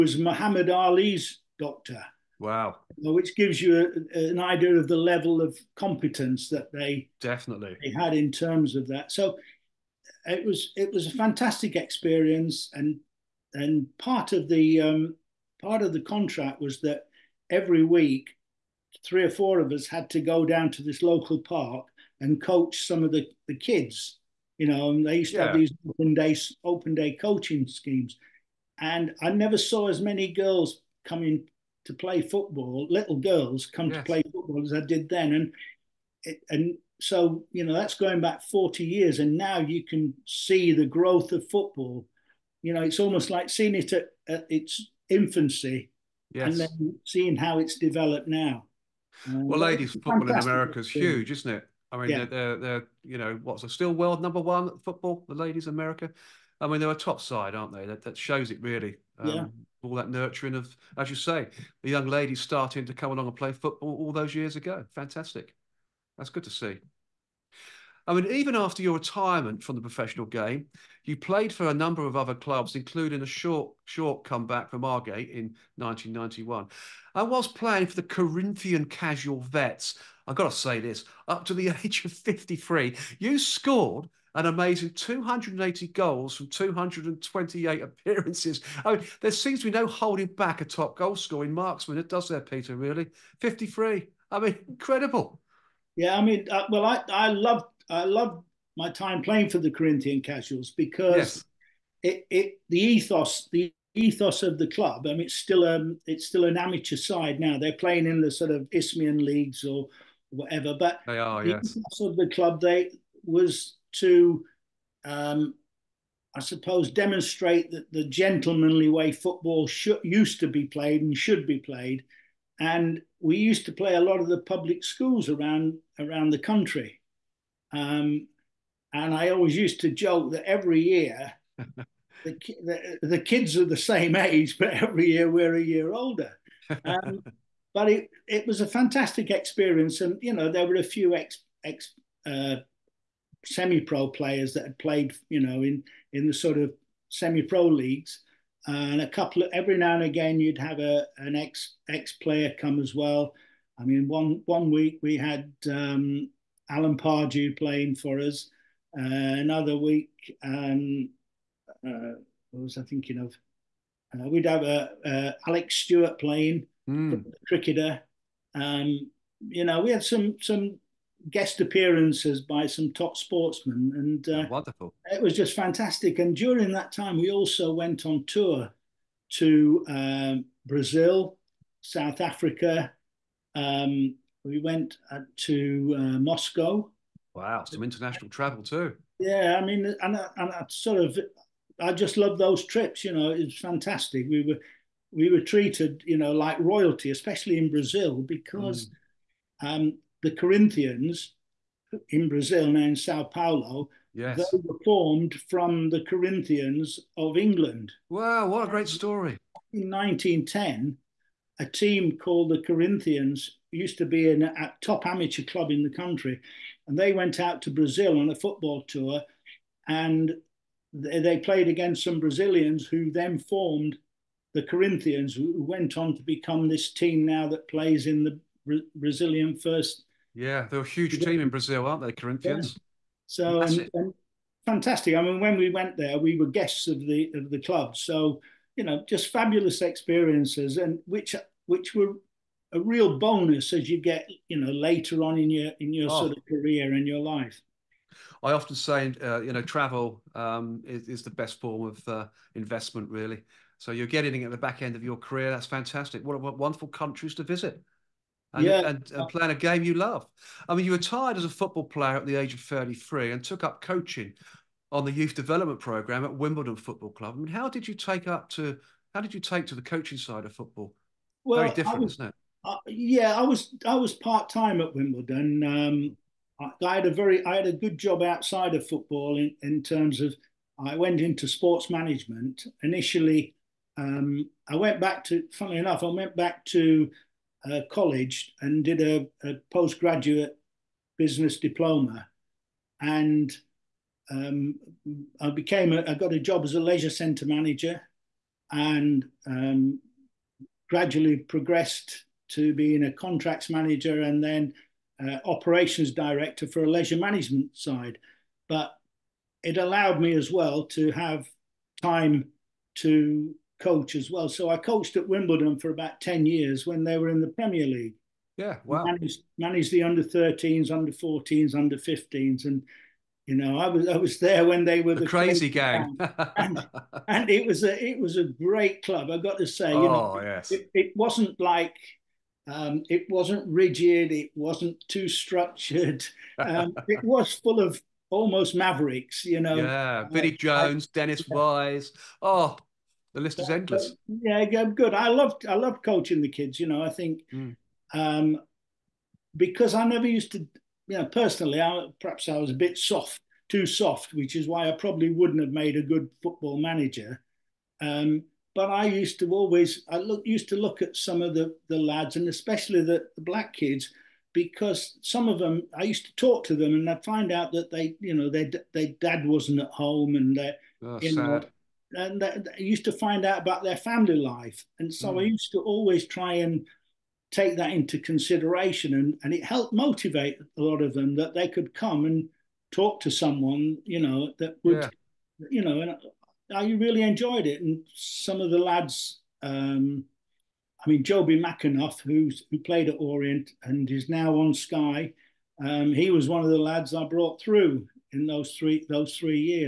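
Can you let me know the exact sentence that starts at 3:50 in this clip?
Yeah, they're a huge team in Brazil, aren't they, Corinthians?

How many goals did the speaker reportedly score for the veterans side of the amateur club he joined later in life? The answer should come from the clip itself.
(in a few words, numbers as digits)
280.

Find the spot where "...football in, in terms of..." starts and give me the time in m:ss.
4:38.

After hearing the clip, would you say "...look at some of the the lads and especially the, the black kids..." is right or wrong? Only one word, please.
right.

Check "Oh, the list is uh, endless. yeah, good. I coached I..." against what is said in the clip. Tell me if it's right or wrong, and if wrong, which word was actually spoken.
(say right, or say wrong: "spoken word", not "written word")
wrong: "loved", not "coached".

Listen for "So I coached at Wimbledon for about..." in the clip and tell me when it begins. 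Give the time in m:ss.
5:14.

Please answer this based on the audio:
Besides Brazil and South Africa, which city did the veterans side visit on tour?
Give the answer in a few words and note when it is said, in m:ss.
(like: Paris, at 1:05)
Moscow, at 3:06.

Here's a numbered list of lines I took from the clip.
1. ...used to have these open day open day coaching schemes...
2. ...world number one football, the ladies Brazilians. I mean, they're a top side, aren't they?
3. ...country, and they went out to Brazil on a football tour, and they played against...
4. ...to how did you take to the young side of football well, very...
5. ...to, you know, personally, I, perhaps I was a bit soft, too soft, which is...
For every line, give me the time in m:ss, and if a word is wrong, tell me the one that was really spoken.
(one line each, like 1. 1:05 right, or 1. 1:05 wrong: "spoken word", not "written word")
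1. 0:25 right
2. 0:53 wrong: "America", not "Brazilians"
3. 3:35 right
4. 4:28 wrong: "coaching", not "young"
5. 5:50 right.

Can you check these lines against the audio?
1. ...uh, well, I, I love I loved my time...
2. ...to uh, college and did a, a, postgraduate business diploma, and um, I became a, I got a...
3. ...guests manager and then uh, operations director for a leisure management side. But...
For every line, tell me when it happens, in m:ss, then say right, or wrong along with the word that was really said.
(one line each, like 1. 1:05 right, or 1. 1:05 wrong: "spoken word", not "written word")
1. 1:36 right
2. 4:46 right
3. 5:03 wrong: "contracts", not "guests".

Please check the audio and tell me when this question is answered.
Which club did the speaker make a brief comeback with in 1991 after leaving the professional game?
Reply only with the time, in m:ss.
1:14.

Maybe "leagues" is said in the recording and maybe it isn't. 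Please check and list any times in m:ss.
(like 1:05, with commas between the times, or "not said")
1:49, 2:27, 5:17.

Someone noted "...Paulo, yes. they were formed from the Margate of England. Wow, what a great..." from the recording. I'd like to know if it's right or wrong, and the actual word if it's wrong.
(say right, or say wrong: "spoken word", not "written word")
wrong: "Corinthians", not "Margate".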